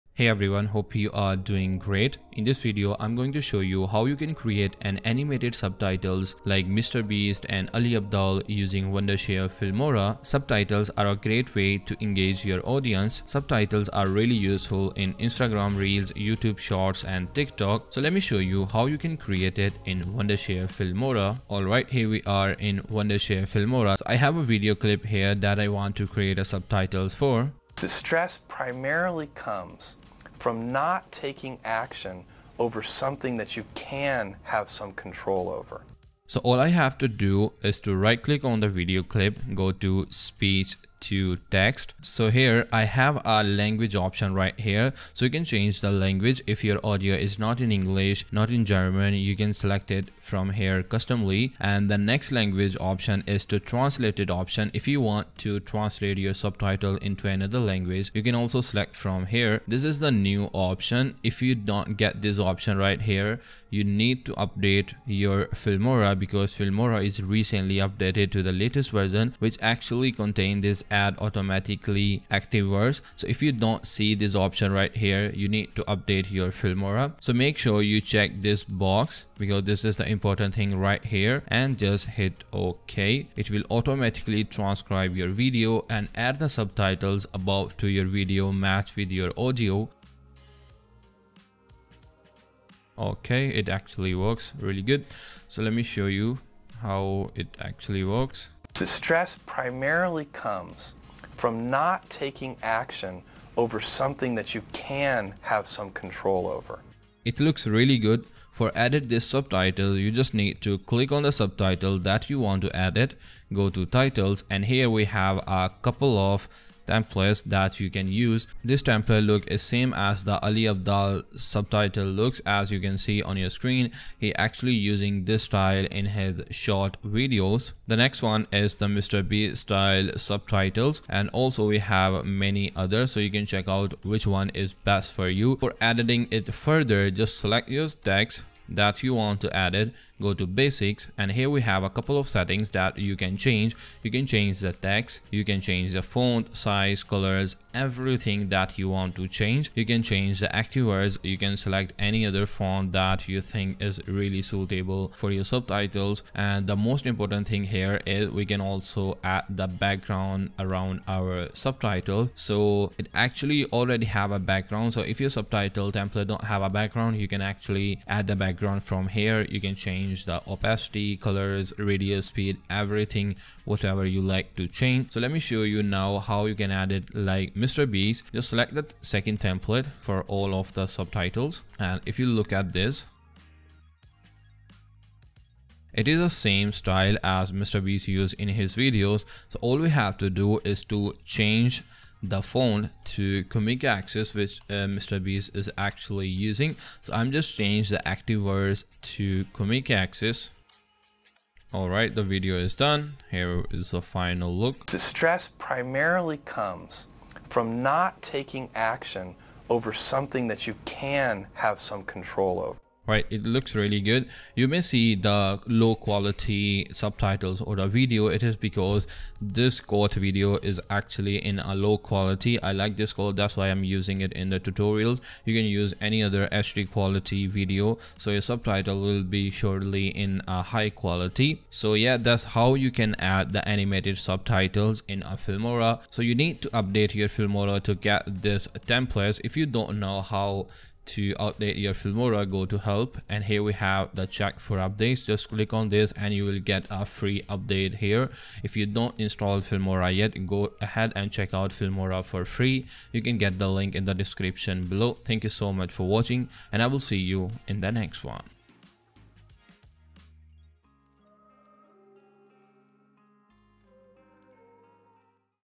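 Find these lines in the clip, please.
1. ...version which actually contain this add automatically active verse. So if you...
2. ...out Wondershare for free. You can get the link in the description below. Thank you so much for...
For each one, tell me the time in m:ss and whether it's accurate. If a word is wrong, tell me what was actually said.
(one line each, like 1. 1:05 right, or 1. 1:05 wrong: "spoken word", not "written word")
1. 1:08 right
2. 4:11 wrong: "Filmora", not "Wondershare".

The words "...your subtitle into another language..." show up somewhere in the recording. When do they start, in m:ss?
0:56.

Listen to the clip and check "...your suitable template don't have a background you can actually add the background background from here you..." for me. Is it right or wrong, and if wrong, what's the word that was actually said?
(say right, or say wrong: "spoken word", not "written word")
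wrong: "subtitle", not "suitable".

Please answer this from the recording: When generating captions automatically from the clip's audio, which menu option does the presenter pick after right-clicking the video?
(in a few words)
Speech to text.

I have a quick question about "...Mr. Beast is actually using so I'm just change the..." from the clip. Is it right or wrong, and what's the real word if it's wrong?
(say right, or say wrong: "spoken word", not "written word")
right.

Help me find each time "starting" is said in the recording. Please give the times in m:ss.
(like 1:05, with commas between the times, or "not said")
not said.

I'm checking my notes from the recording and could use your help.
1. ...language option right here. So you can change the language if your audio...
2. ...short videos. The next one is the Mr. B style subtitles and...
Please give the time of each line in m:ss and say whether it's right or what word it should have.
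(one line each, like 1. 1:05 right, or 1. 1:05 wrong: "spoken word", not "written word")
1. 0:43 right
2. 2:06 right.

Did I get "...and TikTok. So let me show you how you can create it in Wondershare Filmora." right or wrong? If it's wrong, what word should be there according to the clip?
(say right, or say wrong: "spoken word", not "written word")
right.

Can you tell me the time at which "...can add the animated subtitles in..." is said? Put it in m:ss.
3:52.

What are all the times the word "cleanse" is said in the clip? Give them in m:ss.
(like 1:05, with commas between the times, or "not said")
not said.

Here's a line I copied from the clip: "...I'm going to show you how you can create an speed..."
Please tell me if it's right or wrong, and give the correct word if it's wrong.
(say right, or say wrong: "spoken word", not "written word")
wrong: "animated", not "speed".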